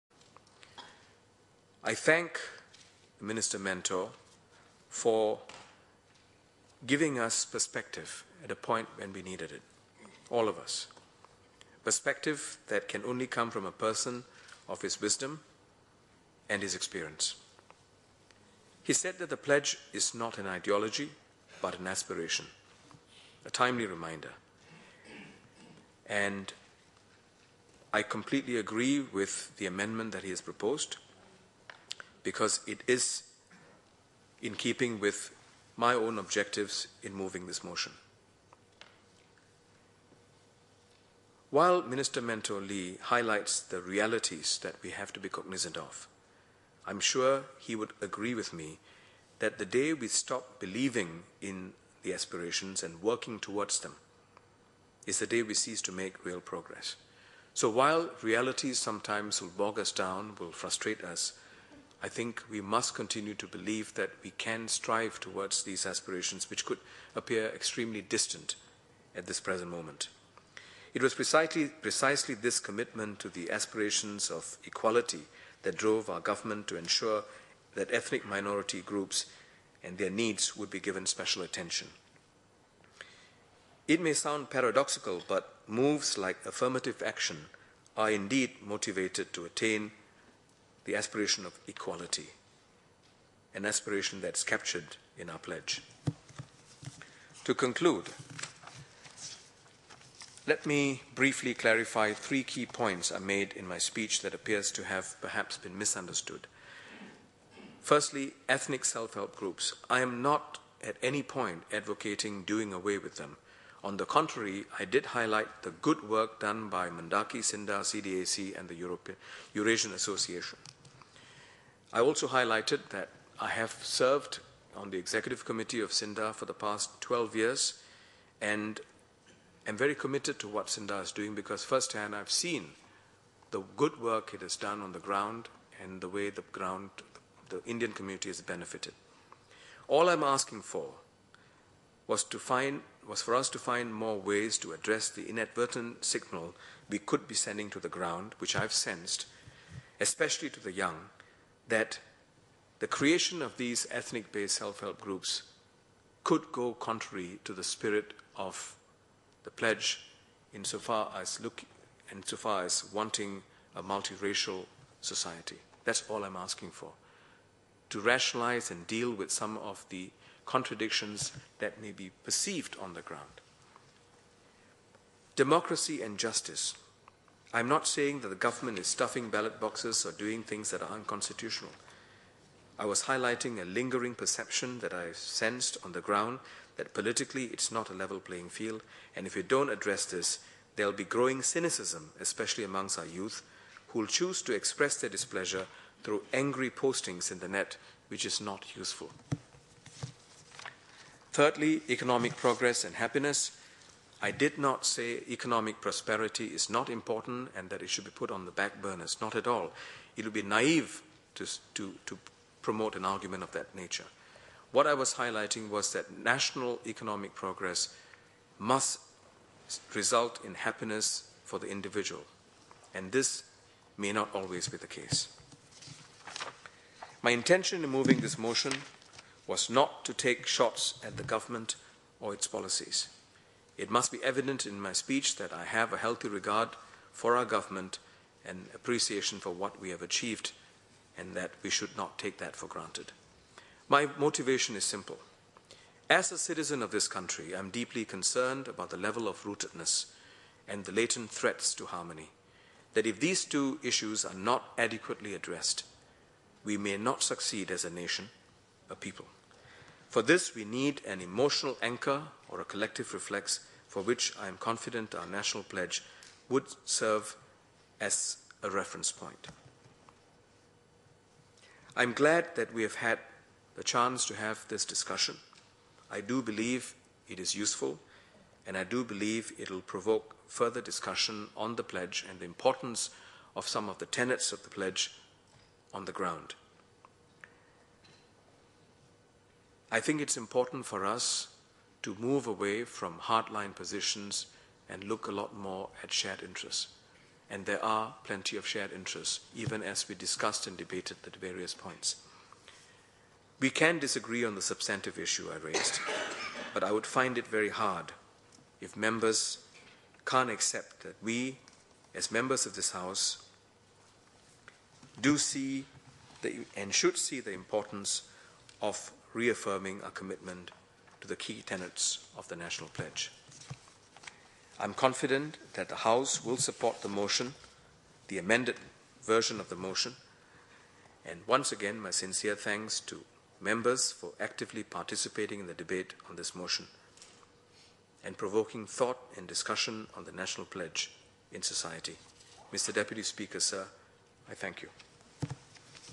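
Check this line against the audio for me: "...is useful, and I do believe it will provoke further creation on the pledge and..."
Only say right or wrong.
wrong.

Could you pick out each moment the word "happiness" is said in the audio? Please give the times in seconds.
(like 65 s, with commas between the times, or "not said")
202 s, 220 s.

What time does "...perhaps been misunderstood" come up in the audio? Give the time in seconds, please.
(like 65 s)
105 s.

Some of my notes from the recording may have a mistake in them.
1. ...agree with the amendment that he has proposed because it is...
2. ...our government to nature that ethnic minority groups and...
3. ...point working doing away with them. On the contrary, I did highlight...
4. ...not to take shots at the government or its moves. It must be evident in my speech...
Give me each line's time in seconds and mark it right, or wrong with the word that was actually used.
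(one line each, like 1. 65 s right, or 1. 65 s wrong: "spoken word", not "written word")
1. 28 s right
2. 76 s wrong: "ensure", not "nature"
3. 111 s wrong: "advocating", not "working"
4. 229 s wrong: "policies", not "moves".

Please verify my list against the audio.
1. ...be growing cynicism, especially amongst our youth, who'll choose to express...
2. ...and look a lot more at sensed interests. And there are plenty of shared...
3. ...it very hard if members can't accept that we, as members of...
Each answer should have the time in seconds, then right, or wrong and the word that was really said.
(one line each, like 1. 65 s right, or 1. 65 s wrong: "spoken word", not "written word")
1. 190 s right
2. 294 s wrong: "shared", not "sensed"
3. 307 s right.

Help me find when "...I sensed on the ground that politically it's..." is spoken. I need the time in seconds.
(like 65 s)
184 s.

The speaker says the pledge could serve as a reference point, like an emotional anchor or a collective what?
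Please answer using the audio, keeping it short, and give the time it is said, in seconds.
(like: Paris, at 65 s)
reflex, at 263 s.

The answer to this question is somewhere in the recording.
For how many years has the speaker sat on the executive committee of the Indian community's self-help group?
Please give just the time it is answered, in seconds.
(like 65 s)
127 s.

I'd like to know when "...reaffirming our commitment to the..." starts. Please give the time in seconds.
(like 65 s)
319 s.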